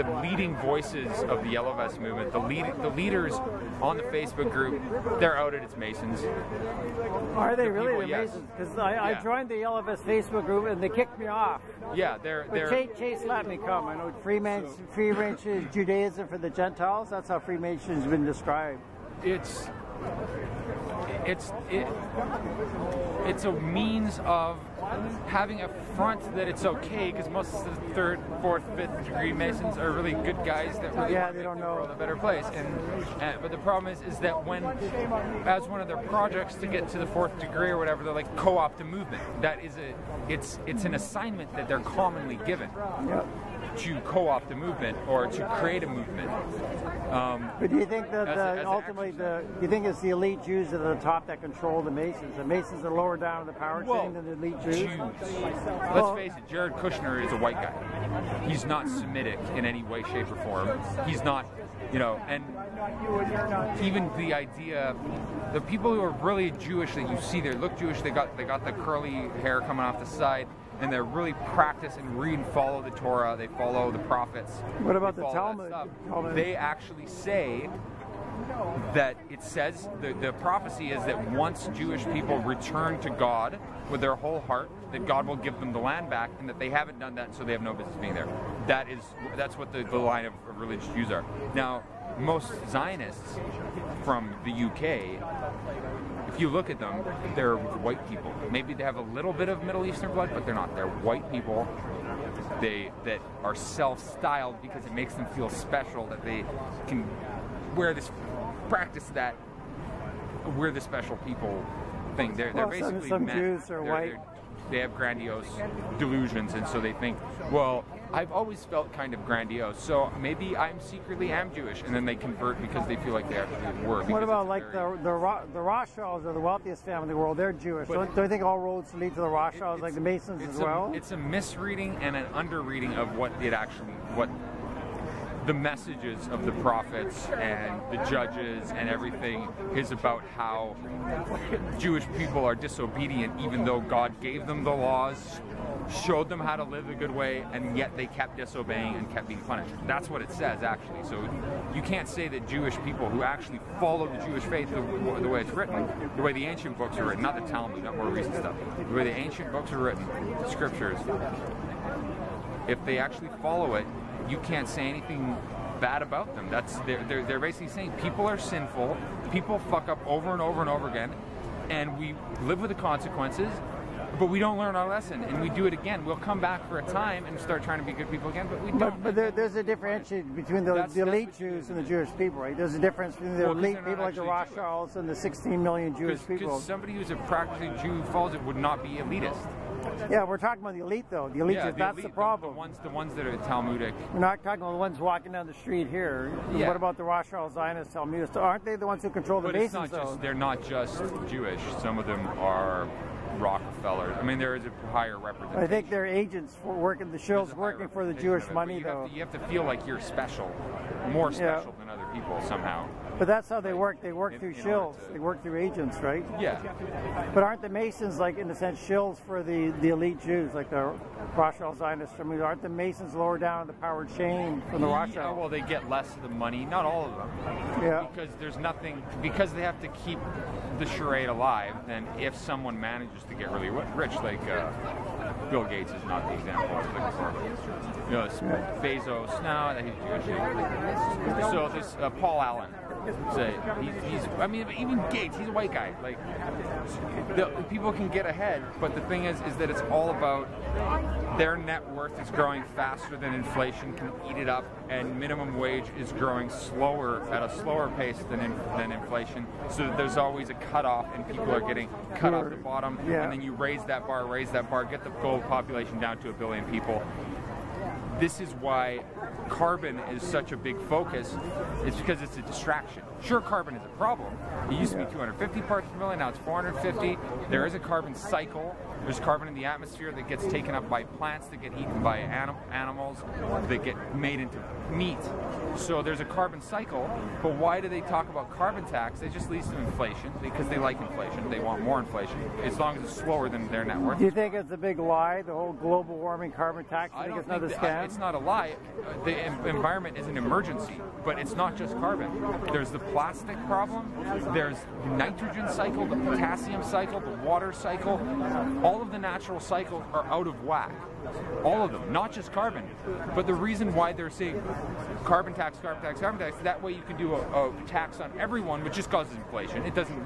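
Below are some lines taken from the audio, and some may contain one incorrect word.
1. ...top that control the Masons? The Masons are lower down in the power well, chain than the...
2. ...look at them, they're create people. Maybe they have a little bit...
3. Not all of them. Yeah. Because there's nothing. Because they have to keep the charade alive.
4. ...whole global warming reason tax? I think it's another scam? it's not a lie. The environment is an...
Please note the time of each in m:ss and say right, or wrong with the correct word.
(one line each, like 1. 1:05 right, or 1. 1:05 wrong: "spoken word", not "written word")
1. 0:50 right
2. 1:36 wrong: "white", not "create"
3. 3:46 right
4. 4:55 wrong: "carbon", not "reason".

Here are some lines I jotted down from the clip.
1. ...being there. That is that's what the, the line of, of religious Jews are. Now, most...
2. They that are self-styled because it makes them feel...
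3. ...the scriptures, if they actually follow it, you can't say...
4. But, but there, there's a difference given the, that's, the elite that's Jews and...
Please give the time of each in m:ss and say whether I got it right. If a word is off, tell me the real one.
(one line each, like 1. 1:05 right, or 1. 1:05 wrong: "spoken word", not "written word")
1. 1:28 right
2. 1:42 right
3. 2:40 right
4. 2:58 wrong: "between", not "given".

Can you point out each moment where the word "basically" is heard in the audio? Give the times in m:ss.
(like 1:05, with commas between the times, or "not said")
1:52, 2:47.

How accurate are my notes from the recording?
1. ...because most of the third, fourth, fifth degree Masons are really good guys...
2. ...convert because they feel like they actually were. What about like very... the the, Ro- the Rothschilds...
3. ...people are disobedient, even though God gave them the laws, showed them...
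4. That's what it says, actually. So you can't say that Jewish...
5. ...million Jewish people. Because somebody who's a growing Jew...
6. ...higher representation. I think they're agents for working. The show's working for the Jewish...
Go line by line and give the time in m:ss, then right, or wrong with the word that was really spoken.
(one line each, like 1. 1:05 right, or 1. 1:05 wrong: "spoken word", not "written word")
1. 0:27 right
2. 2:02 right
3. 2:22 right
4. 2:29 right
5. 3:05 wrong: "practicing", not "growing"
6. 3:24 right.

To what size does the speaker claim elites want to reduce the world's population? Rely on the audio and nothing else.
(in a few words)
a billion.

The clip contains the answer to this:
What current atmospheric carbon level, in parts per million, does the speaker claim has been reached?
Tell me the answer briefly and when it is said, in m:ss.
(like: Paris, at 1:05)
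450, at 4:36.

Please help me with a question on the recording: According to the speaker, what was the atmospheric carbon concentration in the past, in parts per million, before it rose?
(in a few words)
250.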